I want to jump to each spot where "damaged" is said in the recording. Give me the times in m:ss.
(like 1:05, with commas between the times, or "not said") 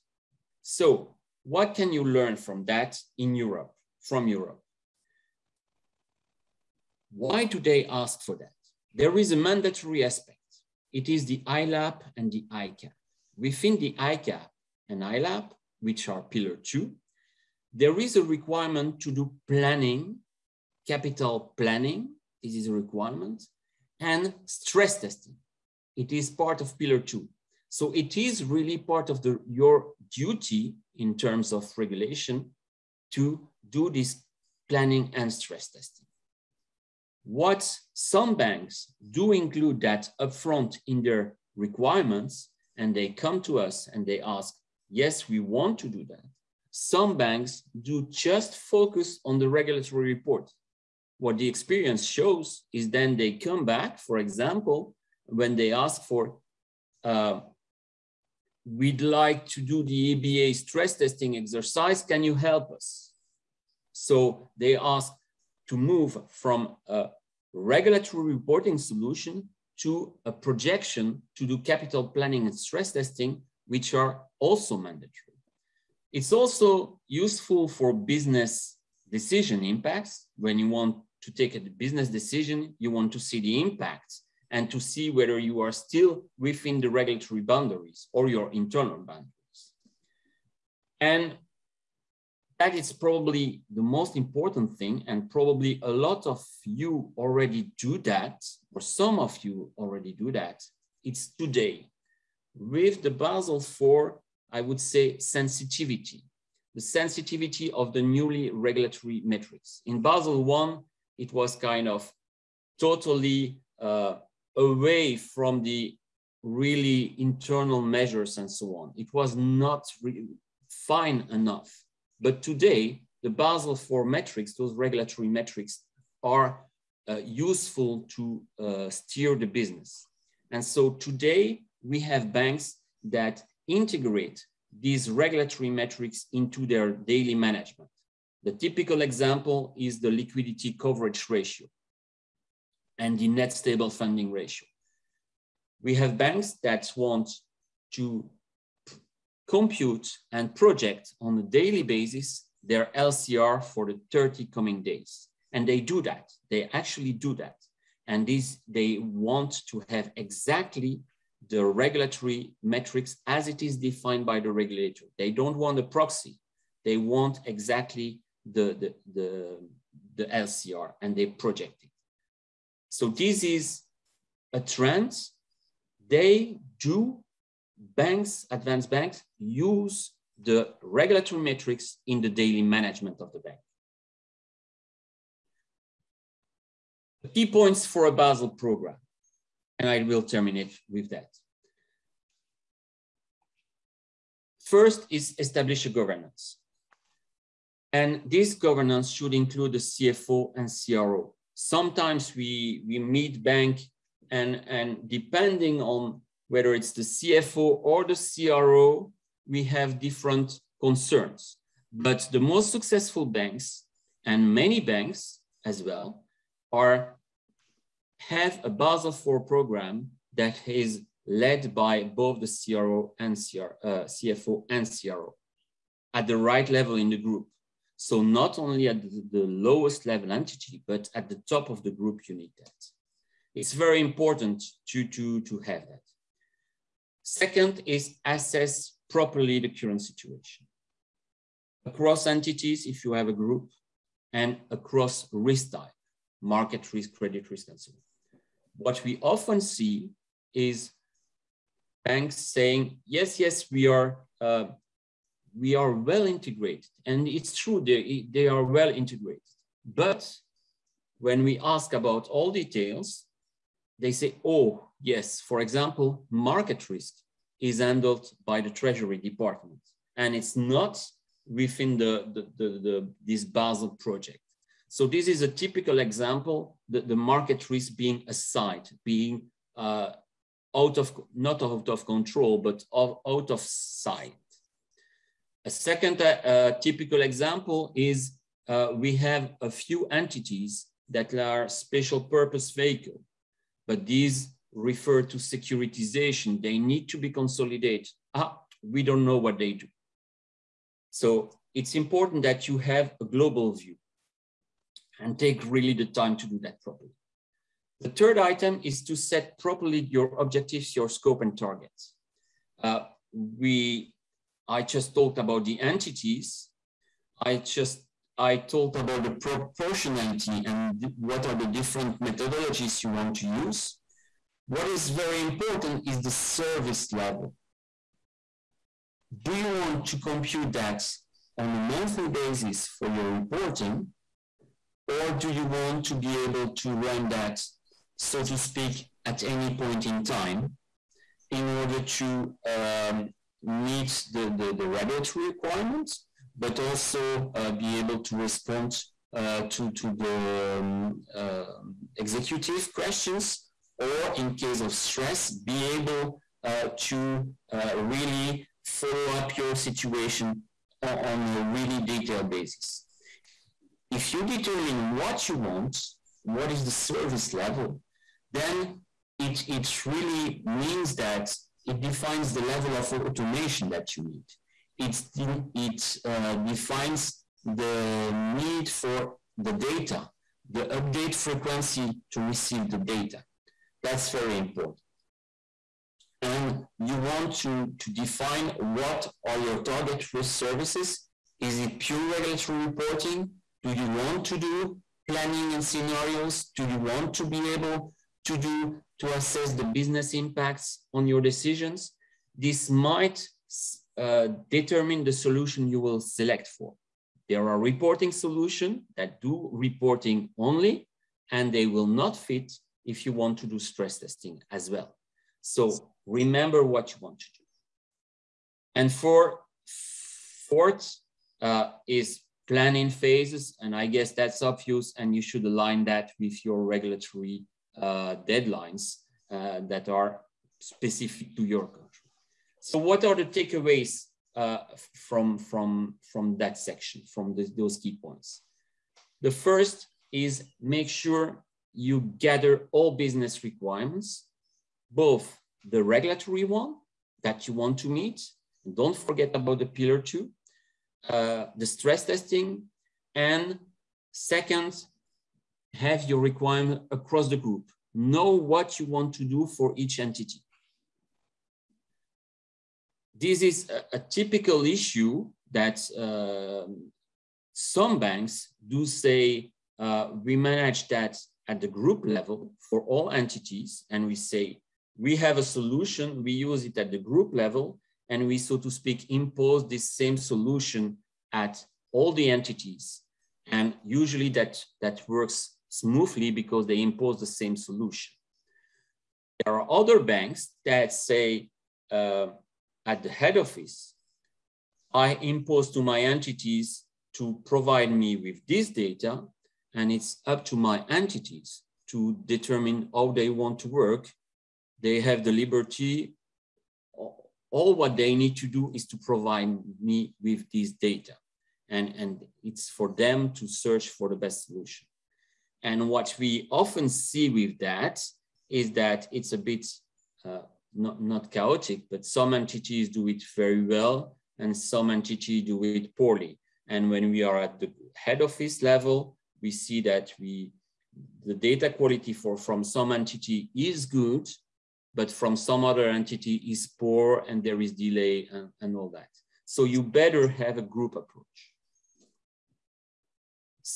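not said.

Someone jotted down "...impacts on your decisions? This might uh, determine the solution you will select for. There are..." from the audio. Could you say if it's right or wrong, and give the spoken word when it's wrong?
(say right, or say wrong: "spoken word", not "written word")
right.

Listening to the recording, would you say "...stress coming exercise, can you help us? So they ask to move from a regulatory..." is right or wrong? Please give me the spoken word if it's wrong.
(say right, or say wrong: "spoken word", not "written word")
wrong: "testing", not "coming".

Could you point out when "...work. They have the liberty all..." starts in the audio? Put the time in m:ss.
8:23.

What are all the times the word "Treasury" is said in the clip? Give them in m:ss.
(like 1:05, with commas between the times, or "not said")
4:28.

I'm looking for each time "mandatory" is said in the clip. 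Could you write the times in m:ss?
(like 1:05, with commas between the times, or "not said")
0:09, 1:14.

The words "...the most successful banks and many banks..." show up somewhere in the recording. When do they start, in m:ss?
3:32.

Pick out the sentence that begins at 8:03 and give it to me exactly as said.
And usually that, that works smoothly because they impose the same solution.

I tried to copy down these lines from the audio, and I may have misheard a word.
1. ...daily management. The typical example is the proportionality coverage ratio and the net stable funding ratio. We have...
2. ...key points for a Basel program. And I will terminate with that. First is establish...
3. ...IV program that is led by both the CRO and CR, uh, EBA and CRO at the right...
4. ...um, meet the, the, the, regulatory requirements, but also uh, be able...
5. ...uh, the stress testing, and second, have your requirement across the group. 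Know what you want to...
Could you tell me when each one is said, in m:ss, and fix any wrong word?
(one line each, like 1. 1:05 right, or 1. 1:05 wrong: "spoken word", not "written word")
1. 2:16 wrong: "liquidity", not "proportionality"
2. 3:07 right
3. 3:39 wrong: "CFO", not "EBA"
4. 5:42 right
5. 7:31 right.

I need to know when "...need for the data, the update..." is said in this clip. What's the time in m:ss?
6:18.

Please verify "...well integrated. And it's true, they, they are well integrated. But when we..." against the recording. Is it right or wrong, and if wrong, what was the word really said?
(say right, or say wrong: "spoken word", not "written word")
right.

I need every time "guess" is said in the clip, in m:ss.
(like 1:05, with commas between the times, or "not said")
7:04.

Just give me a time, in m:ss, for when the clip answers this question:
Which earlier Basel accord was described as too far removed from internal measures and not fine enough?
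1:50.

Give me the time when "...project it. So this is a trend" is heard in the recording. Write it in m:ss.
2:51.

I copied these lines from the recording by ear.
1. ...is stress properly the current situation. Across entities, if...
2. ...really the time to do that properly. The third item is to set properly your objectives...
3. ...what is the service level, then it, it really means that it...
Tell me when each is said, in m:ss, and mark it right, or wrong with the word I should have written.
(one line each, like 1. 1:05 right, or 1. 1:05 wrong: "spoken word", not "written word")
1. 3:57 wrong: "assess", not "stress"
2. 5:05 right
3. 6:06 right.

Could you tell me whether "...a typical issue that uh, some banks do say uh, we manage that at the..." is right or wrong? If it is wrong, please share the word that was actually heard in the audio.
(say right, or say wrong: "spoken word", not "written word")
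right.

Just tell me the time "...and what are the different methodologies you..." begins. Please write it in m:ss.
5:20.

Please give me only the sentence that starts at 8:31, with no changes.
And, and it's for them to search for the best solution.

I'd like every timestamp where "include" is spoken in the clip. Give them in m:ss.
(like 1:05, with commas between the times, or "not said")
0:39, 3:19.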